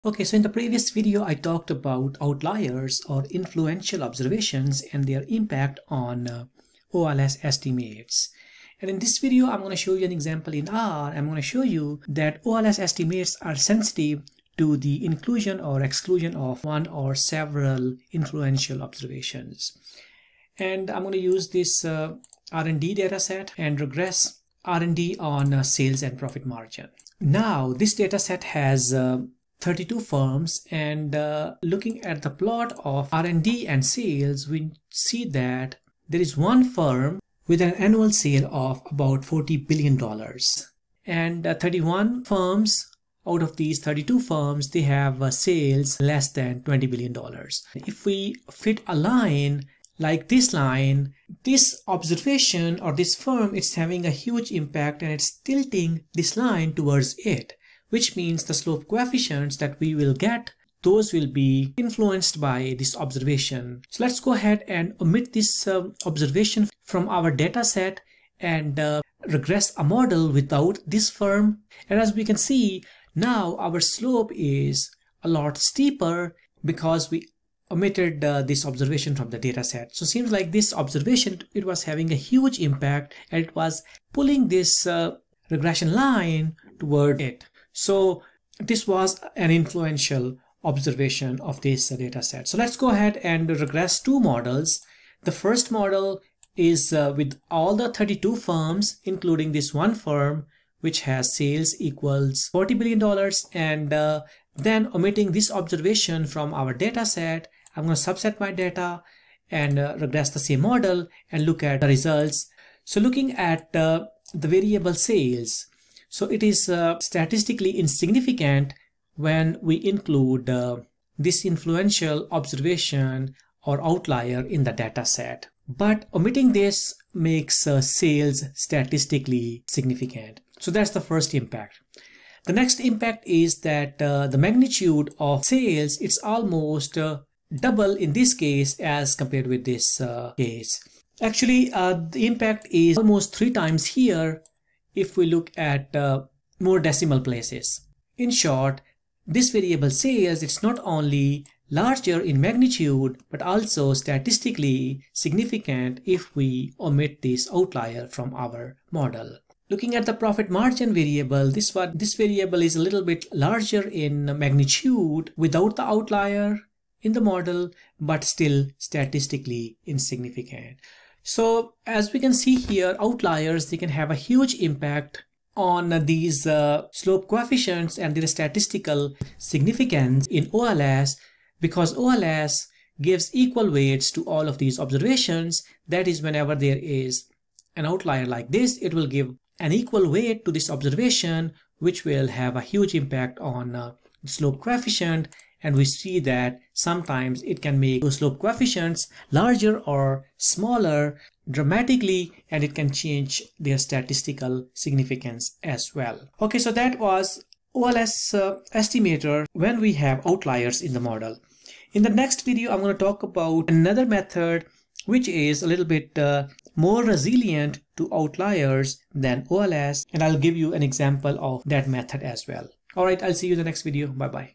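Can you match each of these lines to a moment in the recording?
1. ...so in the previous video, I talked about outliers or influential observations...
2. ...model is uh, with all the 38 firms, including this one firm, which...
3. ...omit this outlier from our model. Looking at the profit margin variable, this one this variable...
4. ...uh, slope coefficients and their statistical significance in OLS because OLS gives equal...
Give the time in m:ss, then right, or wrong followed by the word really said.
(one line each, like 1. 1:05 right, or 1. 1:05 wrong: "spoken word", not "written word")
1. 0:00 right
2. 1:35 wrong: "32", not "38"
3. 2:36 right
4. 2:56 right.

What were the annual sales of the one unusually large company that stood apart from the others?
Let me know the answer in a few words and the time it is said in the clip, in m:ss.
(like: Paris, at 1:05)
40 billion dollars, at 0:39.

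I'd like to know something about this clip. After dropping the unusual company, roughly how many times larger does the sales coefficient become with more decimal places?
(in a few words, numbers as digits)
3 times.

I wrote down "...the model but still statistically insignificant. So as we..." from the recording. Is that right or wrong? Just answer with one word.
right.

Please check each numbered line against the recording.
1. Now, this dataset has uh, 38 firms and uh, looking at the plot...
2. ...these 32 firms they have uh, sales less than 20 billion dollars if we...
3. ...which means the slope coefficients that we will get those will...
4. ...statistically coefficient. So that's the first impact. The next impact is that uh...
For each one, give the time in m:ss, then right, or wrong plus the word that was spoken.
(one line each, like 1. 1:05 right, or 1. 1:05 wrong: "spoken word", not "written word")
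1. 0:27 wrong: "32", not "38"
2. 0:43 right
3. 0:57 right
4. 2:08 wrong: "significant", not "coefficient".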